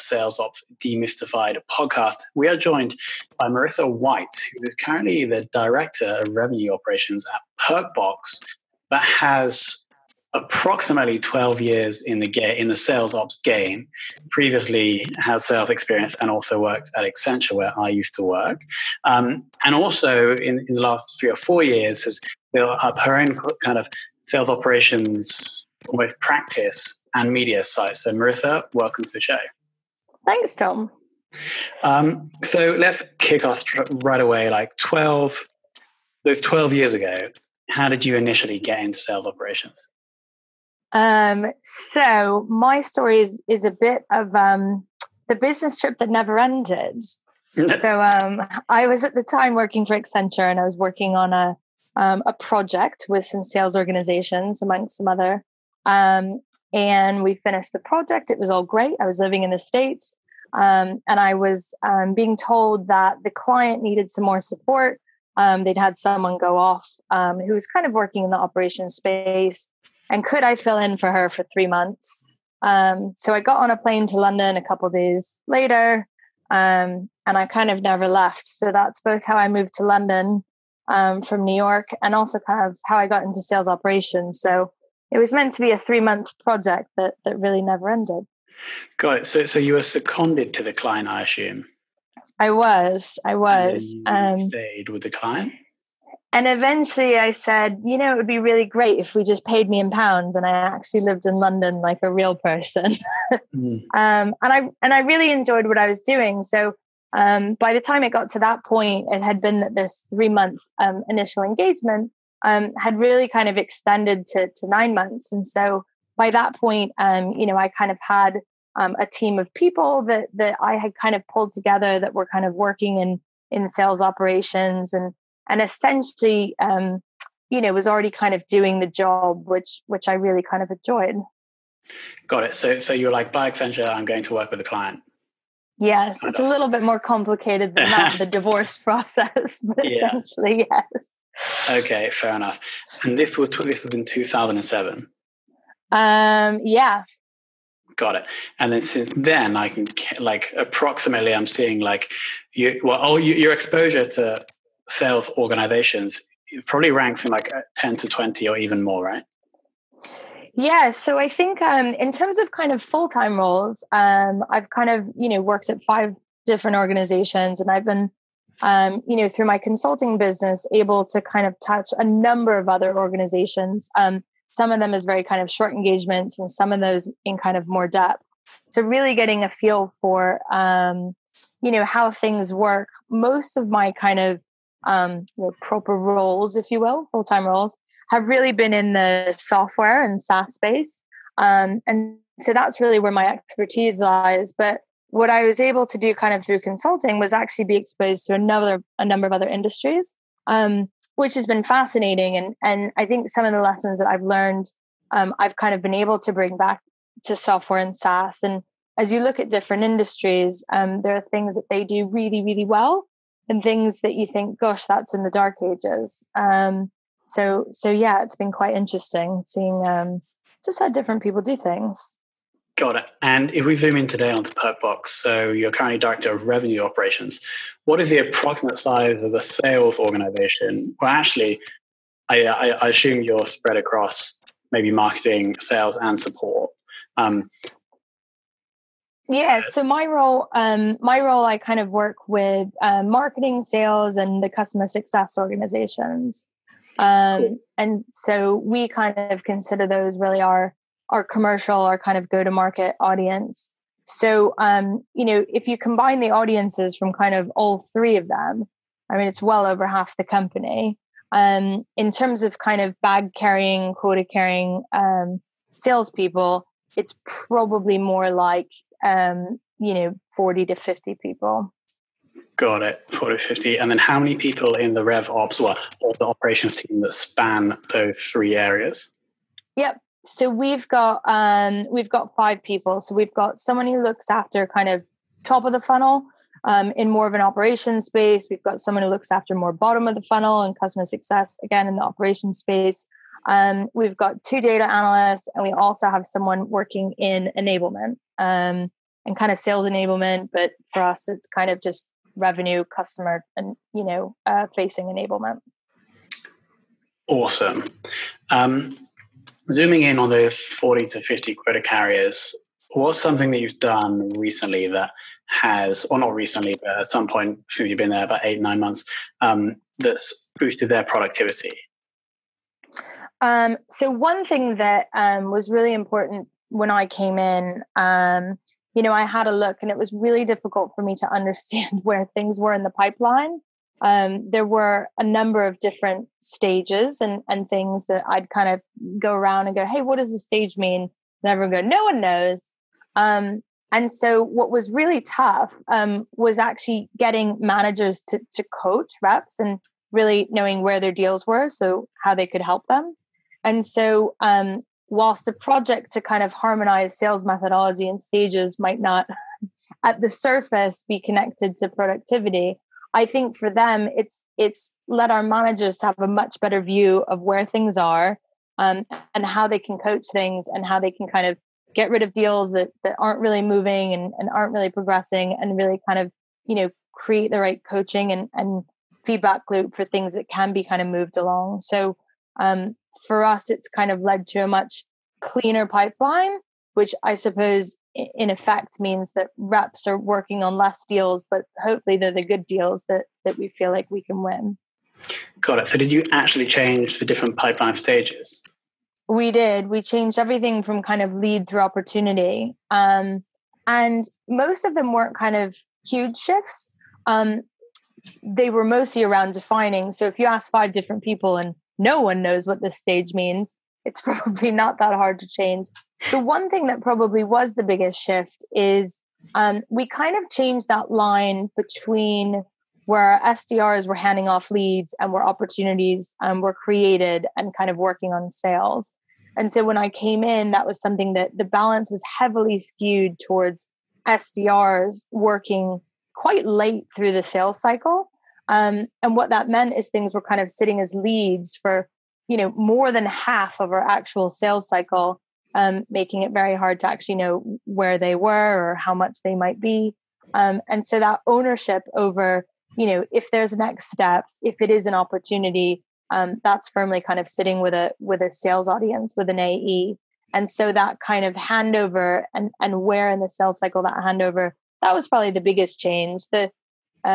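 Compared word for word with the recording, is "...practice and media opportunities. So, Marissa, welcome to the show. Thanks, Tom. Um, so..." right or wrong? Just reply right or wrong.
wrong.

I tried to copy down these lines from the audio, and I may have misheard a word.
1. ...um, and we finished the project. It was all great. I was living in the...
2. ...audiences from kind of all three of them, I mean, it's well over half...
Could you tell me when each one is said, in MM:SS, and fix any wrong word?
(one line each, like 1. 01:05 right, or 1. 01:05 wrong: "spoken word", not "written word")
1. 00:55 right
2. 04:16 right.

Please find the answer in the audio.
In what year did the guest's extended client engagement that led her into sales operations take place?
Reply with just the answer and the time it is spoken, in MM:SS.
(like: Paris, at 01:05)
2007, at 02:24.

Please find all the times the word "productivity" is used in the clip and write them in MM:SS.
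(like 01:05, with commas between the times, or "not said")
05:21, 06:01.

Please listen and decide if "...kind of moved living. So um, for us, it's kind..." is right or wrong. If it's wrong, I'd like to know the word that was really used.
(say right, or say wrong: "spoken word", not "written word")
wrong: "along", not "living".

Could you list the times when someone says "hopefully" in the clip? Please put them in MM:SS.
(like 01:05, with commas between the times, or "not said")
06:31.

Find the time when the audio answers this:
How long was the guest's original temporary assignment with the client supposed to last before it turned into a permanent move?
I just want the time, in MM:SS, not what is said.
01:11.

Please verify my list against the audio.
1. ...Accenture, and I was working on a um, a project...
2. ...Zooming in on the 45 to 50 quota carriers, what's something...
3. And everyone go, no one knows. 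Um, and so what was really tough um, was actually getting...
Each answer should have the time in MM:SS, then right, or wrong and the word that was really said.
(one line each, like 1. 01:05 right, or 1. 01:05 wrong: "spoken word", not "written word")
1. 00:49 right
2. 05:09 wrong: "40", not "45"
3. 05:41 right.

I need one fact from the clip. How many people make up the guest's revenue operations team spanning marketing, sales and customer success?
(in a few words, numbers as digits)
5.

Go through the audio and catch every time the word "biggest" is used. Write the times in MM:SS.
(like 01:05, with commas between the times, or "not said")
06:57, 07:45.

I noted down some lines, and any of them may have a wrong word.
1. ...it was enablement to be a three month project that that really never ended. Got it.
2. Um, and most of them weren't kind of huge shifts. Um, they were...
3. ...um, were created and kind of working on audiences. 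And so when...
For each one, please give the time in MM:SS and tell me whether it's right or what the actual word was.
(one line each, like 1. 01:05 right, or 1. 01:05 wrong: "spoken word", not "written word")
1. 01:25 wrong: "meant", not "enablement"
2. 06:42 right
3. 07:06 wrong: "sales", not "audiences".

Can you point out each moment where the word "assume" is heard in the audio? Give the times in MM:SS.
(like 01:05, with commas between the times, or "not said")
01:31, 03:52.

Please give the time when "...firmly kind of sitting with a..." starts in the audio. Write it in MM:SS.
07:36.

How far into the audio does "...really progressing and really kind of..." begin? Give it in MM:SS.
06:14.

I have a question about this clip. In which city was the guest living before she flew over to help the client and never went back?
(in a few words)
New York.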